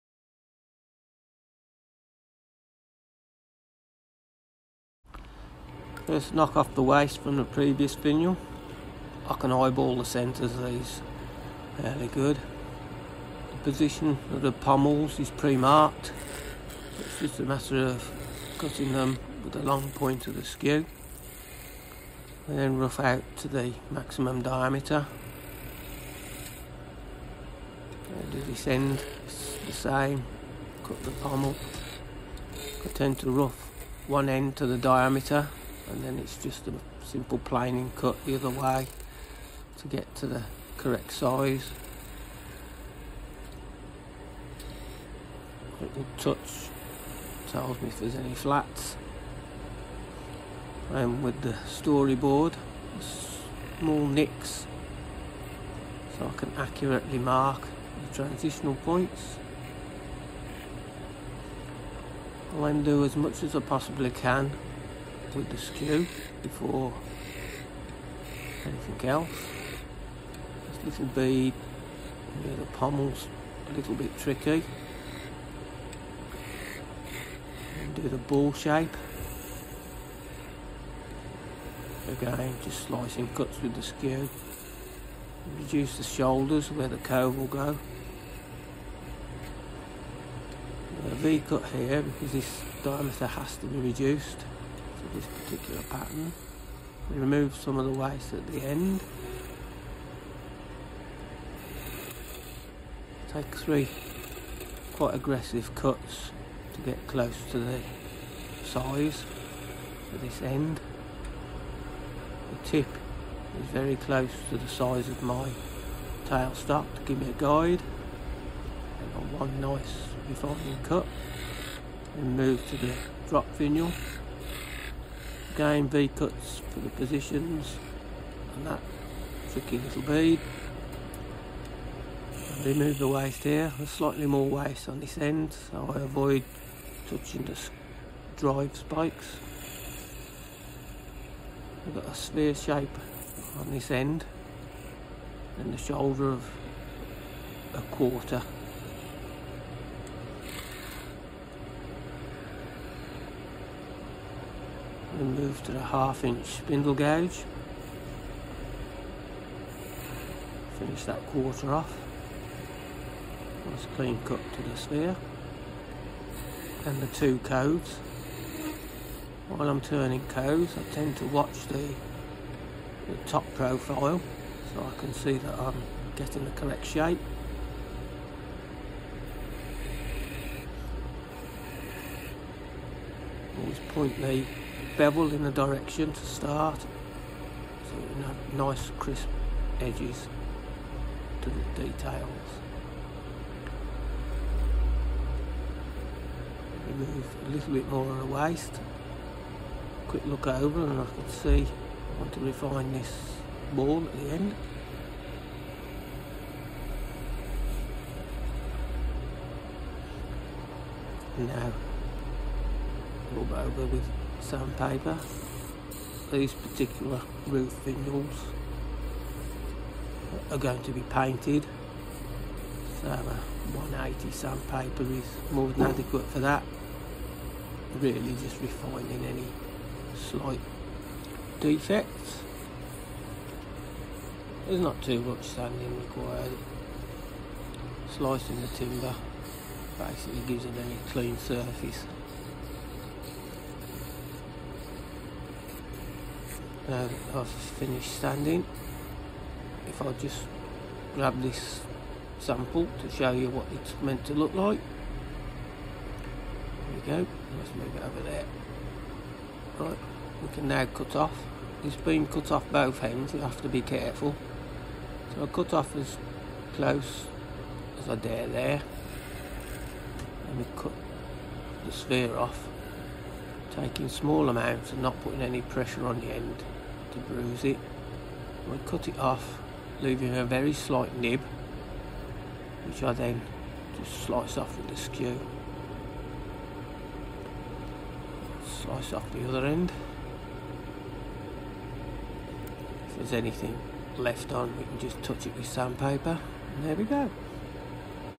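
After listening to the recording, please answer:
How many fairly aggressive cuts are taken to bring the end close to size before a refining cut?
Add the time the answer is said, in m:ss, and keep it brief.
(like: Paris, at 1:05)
3, at 1:43.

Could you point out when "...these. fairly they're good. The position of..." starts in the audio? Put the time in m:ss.
0:10.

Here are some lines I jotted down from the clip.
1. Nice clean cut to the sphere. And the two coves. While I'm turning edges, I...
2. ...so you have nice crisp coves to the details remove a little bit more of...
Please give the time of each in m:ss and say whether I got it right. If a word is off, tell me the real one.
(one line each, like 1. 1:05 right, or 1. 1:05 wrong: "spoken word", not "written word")
1. 2:43 wrong: "coves", not "edges"
2. 3:06 wrong: "edges", not "coves".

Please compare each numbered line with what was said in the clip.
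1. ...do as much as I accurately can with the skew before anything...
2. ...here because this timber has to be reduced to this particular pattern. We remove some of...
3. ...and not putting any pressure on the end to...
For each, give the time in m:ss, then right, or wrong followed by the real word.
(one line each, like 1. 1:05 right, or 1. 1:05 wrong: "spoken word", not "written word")
1. 1:02 wrong: "possibly", not "accurately"
2. 1:31 wrong: "diameter", not "timber"
3. 4:34 right.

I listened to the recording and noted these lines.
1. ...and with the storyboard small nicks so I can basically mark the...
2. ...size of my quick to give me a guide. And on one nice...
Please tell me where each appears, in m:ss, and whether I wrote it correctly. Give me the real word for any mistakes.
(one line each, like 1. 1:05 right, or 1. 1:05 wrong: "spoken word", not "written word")
1. 0:50 wrong: "accurately", not "basically"
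2. 1:54 wrong: "tailstock", not "quick".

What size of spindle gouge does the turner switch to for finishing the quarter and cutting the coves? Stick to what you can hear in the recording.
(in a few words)
Half inch.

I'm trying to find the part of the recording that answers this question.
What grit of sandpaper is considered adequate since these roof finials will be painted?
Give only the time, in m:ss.
3:43.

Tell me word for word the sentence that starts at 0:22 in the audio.
And then rough out to the maximum diameter.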